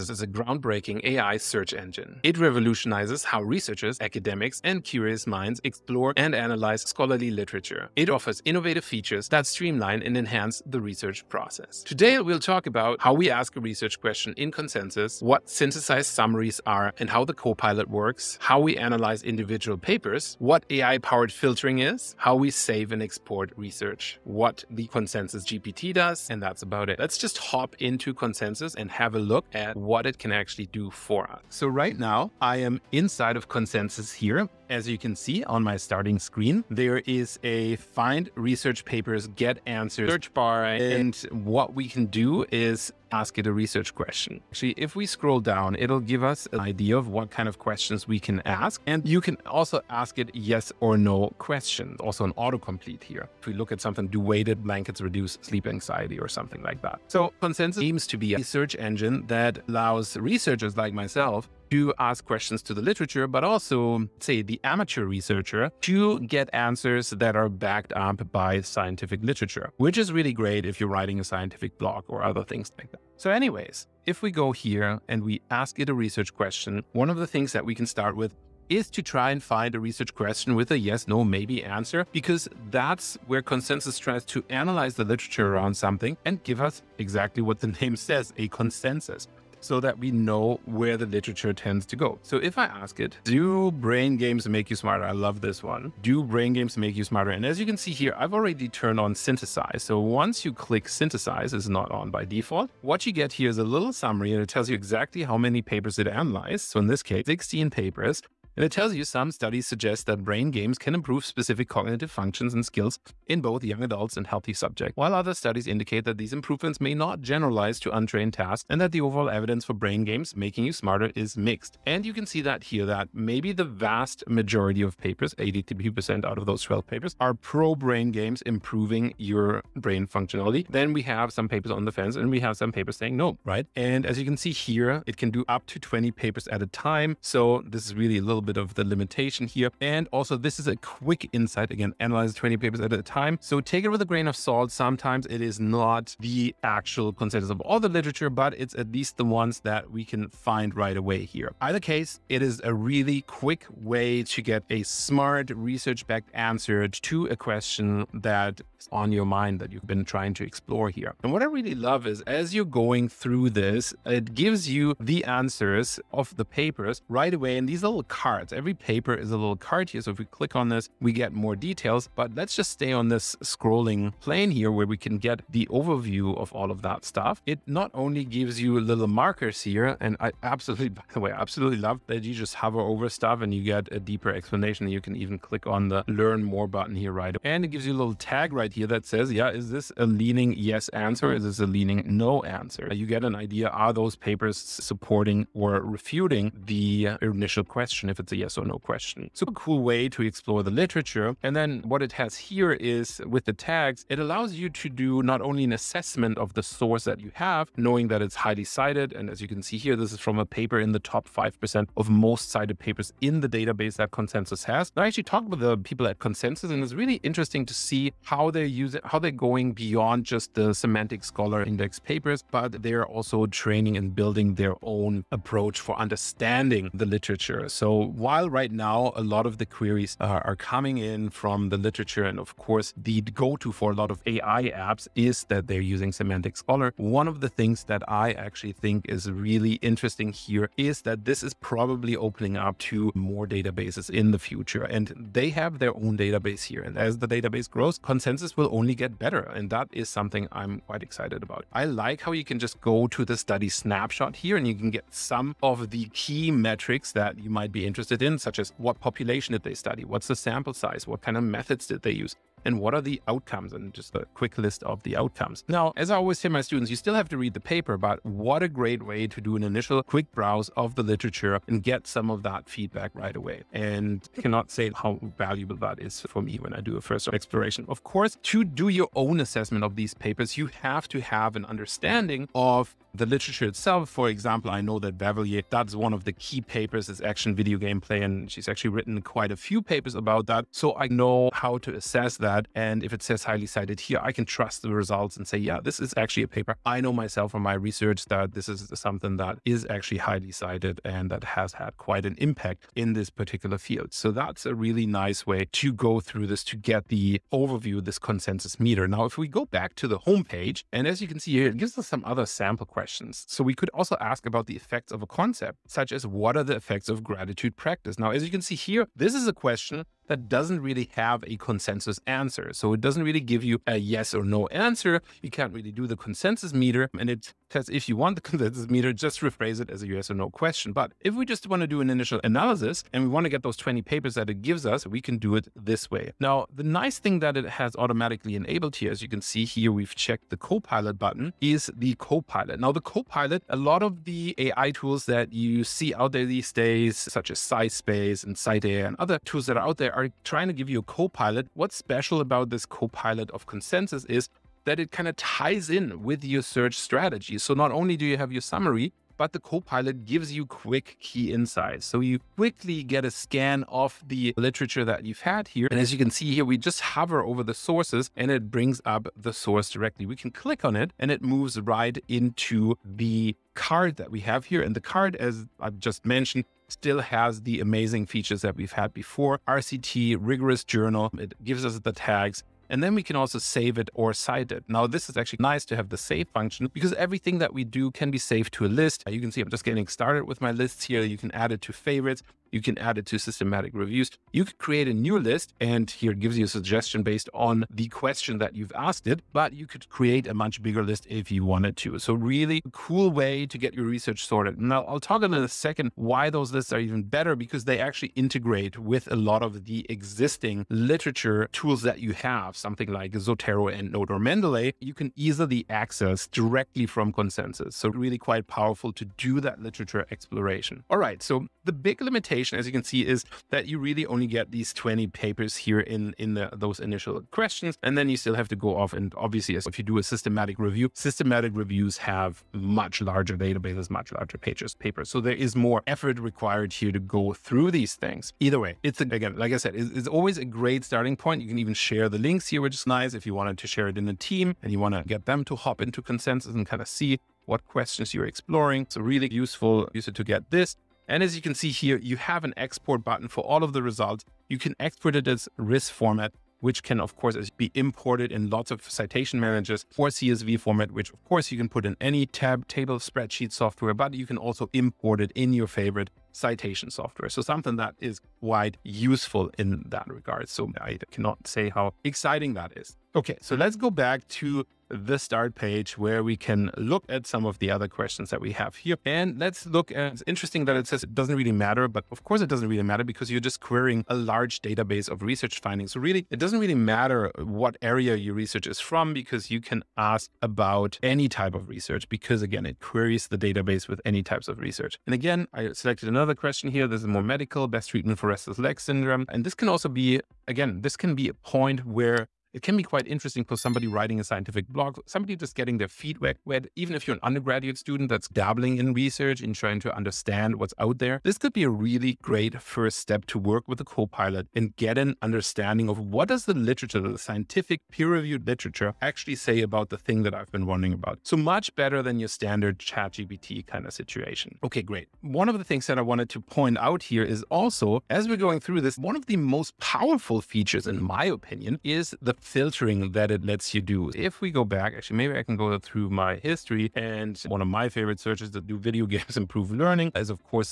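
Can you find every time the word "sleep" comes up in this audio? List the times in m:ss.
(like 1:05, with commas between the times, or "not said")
0:55.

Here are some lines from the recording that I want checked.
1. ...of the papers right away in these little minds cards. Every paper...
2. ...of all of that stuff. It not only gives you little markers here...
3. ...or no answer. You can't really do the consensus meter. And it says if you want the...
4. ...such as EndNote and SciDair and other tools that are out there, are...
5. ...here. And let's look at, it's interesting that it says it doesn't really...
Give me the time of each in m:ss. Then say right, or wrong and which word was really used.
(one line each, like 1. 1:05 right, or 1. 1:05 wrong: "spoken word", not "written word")
1. 2:46 wrong: "cards", not "minds"
2. 2:56 right
3. 5:24 right
4. 5:47 wrong: "SciSpace", not "EndNote"
5. 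7:58 right.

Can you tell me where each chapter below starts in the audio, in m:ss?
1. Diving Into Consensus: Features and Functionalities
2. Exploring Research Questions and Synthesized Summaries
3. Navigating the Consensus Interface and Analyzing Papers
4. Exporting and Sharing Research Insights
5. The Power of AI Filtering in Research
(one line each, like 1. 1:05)
1. 0:30
2. 1:13
3. 2:40
4. 7:30
5. 8:44.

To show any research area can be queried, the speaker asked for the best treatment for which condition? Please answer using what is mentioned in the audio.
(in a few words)
restless leg syndrome.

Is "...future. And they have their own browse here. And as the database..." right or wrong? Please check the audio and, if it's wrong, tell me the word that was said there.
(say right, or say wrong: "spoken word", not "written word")
wrong: "database", not "browse".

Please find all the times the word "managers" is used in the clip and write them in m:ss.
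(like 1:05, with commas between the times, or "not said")
7:39.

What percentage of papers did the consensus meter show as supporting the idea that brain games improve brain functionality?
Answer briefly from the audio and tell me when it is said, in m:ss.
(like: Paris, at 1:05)
82%, at 2:05.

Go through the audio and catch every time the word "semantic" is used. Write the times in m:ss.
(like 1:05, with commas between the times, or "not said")
3:40, 3:56.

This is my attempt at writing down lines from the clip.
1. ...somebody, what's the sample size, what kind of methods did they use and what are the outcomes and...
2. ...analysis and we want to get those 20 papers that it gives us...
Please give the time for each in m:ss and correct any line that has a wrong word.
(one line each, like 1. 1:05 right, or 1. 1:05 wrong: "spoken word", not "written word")
1. 4:19 wrong: "study", not "somebody"
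2. 5:32 right.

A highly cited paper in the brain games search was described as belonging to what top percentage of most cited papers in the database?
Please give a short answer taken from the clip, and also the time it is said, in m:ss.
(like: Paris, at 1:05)
top 5%, at 3:30.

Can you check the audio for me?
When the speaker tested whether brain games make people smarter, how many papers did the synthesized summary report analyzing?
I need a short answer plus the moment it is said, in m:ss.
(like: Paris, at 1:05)
16, at 1:47.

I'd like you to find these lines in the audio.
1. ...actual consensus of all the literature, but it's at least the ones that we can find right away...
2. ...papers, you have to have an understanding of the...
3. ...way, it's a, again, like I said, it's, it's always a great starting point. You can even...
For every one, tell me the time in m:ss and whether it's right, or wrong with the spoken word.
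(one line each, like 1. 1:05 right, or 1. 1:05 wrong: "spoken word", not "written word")
1. 2:26 right
2. 4:40 right
3. 7:18 right.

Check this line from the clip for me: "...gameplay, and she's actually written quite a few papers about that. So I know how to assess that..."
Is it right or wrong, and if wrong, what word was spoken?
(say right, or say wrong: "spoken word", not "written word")
right.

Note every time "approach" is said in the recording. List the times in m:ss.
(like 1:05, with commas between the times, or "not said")
3:45.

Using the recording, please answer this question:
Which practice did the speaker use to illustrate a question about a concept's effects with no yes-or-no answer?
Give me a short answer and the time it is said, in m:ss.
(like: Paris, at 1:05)
gratitude practice, at 5:17.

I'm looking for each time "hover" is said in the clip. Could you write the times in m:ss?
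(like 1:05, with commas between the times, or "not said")
3:02, 6:07.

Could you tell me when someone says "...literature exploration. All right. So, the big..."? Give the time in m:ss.
6:59.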